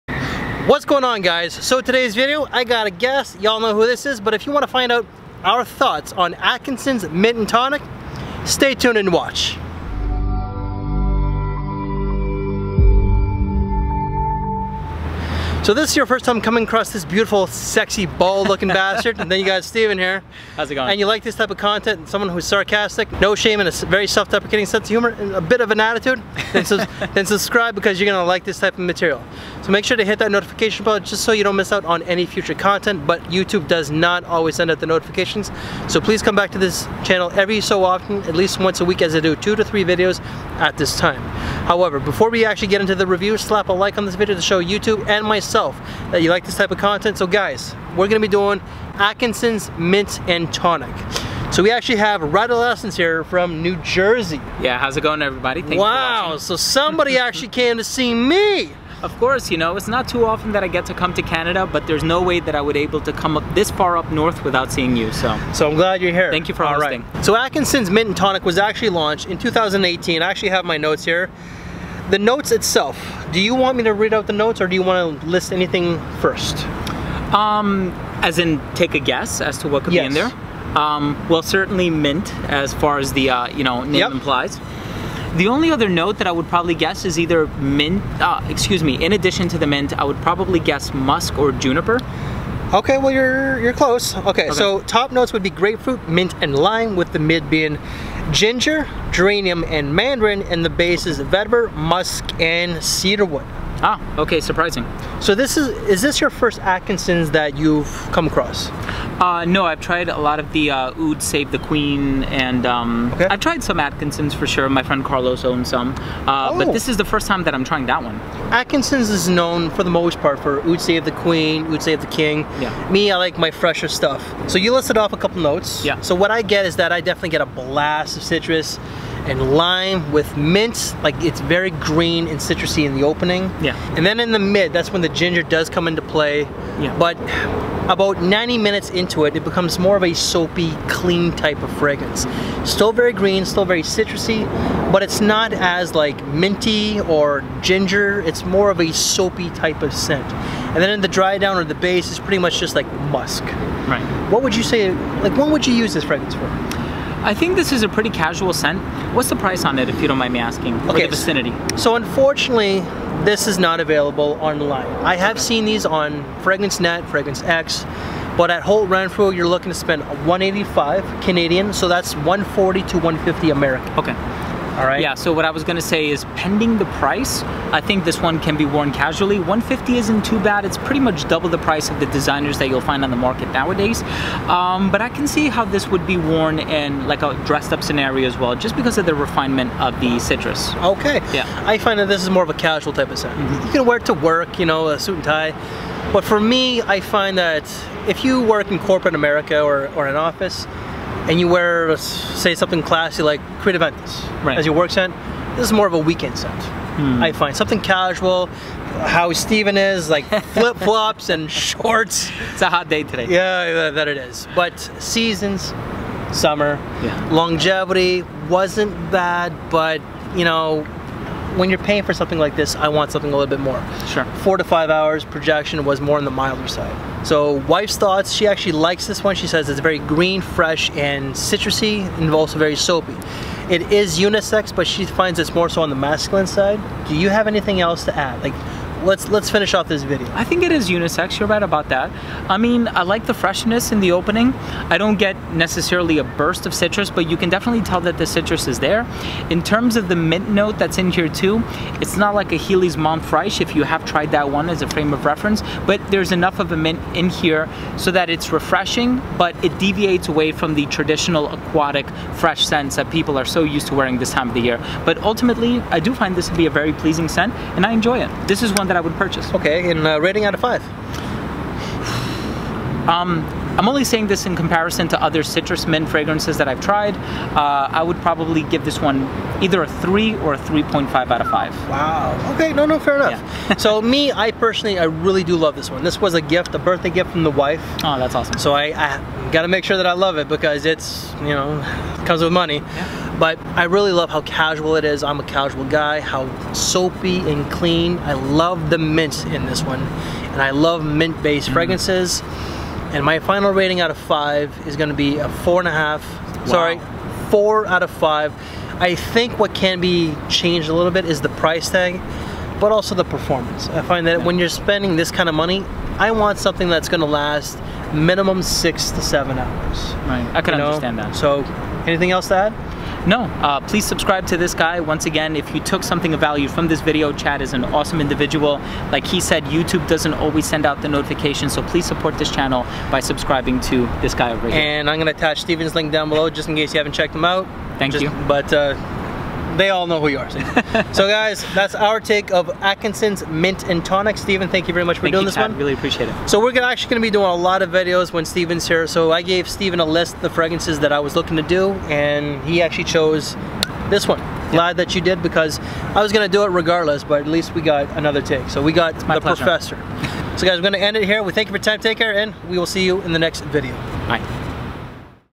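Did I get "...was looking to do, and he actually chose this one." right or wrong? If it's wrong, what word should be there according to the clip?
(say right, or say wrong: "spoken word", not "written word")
right.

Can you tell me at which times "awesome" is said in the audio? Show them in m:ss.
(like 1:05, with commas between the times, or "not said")
4:48, 5:27.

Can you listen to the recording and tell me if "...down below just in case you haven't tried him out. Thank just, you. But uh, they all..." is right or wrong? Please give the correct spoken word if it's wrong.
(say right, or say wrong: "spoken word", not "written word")
wrong: "checked", not "tried".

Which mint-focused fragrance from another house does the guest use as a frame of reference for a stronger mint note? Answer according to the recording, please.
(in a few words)
Heeley's Menthe Fraiche.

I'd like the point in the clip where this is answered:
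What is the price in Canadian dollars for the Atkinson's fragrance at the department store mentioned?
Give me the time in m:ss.
2:50.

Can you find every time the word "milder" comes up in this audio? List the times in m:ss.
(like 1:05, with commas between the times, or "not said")
3:46.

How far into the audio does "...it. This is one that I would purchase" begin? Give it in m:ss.
4:28.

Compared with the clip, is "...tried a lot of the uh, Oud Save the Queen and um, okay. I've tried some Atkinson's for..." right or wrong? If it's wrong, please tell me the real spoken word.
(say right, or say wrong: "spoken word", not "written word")
right.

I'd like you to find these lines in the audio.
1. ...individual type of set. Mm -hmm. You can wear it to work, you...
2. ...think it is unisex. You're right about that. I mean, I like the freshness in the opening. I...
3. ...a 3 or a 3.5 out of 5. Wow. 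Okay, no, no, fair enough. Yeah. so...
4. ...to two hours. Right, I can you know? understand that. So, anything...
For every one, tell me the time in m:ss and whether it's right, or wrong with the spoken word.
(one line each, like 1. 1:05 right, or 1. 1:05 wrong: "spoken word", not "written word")
1. 3:12 wrong: "casual", not "individual"
2. 4:00 right
3. 4:39 right
4. 5:19 wrong: "seven", not "two".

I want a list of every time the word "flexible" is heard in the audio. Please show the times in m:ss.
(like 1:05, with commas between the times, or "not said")
not said.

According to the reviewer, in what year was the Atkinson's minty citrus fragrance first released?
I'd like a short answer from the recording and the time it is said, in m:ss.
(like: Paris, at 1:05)
2018, at 1:09.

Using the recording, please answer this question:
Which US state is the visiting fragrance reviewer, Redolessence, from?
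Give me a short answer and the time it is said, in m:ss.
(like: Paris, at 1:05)
New Jersey, at 0:53.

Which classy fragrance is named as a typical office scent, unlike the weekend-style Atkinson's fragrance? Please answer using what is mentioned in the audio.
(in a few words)
Creed Aventus.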